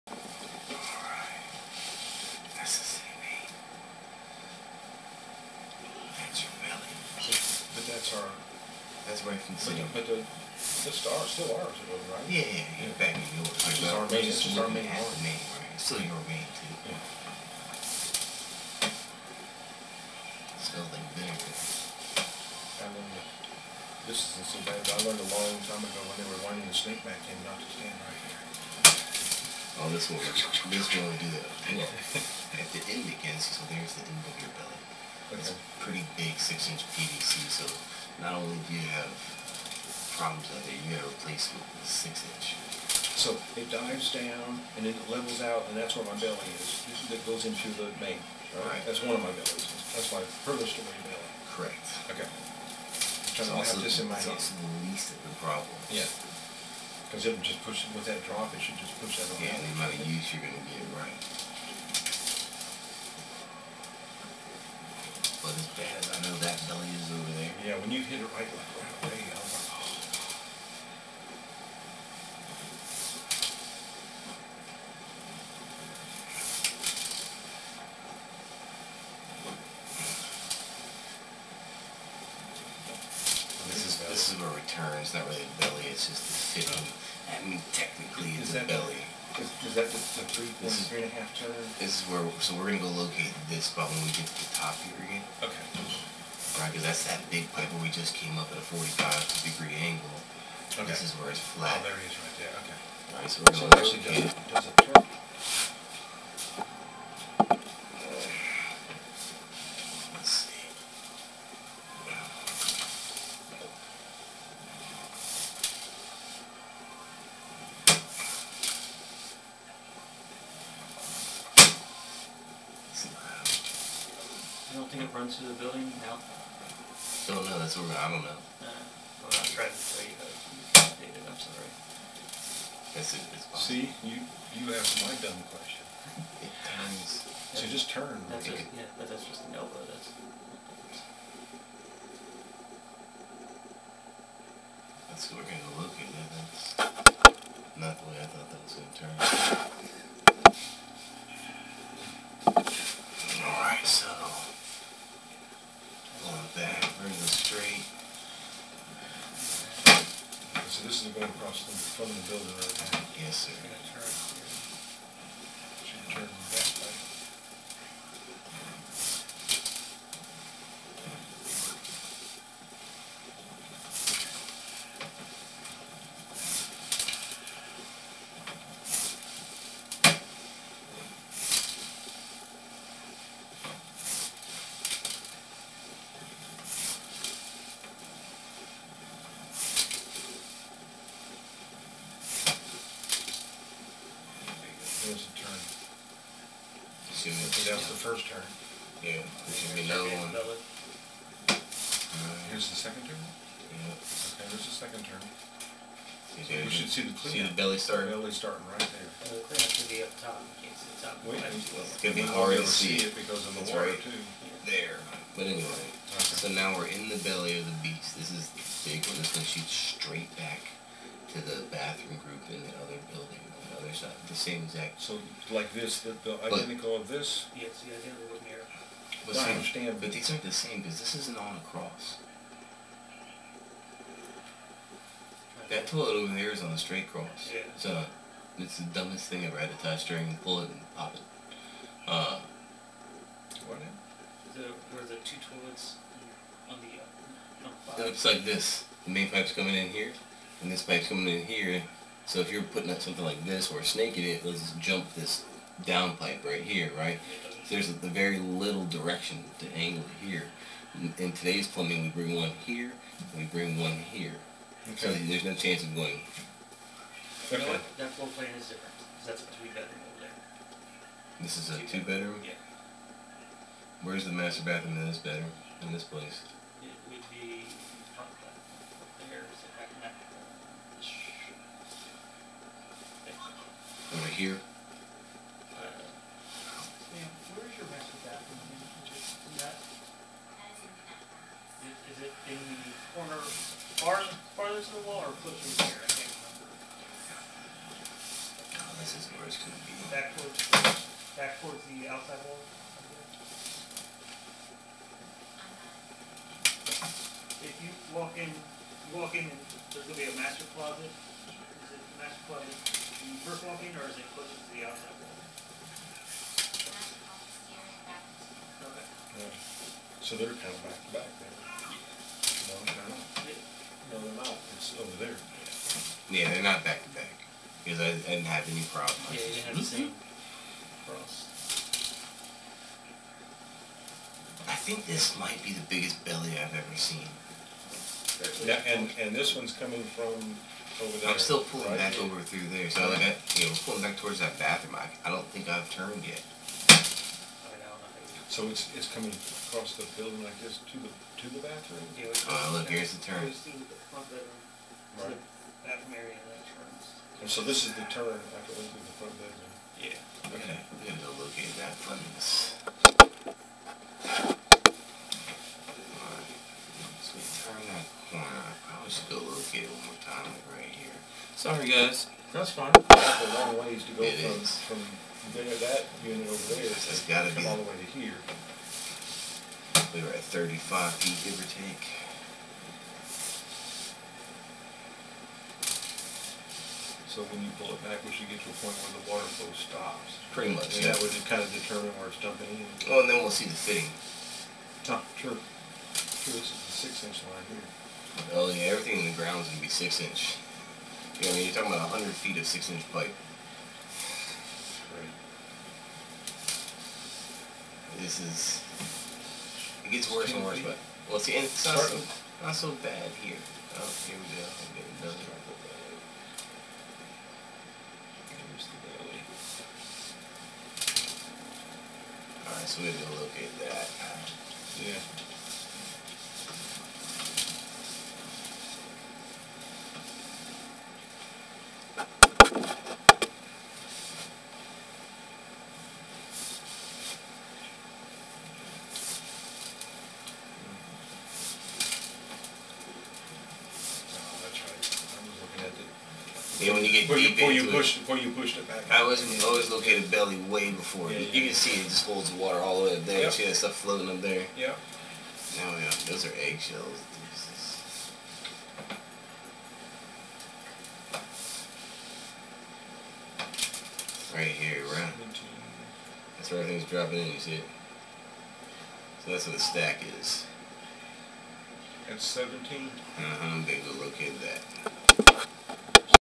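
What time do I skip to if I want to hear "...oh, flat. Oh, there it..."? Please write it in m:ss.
1:41.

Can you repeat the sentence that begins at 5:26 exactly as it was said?
Yeah, they're not back to back.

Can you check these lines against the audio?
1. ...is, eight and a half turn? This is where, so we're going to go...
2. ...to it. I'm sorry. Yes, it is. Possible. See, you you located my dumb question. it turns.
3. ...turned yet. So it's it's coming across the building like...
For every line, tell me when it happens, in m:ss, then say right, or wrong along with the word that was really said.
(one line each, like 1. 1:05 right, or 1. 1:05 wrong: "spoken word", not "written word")
1. 1:30 wrong: "three", not "eight"
2. 2:10 wrong: "asked", not "located"
3. 5:45 right.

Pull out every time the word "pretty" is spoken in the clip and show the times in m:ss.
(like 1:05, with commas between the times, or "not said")
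0:35, 6:30.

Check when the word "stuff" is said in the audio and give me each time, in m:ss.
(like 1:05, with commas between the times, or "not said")
7:33.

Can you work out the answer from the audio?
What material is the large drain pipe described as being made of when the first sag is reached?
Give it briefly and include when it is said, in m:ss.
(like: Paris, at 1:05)
PVC, at 0:36.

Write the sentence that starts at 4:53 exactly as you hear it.
corner far, farthest the wall or here?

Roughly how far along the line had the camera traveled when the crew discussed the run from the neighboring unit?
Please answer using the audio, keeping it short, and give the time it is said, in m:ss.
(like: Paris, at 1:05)
35 feet, at 6:20.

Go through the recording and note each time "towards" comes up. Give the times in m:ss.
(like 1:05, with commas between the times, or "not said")
5:01, 5:44.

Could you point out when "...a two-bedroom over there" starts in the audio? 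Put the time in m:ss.
4:29.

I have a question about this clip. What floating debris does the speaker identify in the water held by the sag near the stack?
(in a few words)
Eggshells.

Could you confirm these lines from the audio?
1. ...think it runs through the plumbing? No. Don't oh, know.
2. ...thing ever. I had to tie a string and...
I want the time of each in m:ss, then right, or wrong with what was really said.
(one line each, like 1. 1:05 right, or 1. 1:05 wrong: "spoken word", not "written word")
1. 2:04 wrong: "building", not "plumbing"
2. 3:59 right.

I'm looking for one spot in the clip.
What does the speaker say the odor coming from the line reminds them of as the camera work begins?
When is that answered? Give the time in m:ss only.
0:21.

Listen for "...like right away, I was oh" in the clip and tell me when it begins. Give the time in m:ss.
1:08.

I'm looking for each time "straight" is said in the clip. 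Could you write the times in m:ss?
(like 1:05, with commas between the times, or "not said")
3:39, 3:56.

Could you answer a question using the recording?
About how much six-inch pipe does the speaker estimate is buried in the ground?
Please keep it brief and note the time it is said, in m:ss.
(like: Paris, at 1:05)
100 feet, at 6:42.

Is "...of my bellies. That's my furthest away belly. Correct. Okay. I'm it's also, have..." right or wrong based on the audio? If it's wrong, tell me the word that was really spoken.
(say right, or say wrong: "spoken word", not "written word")
right.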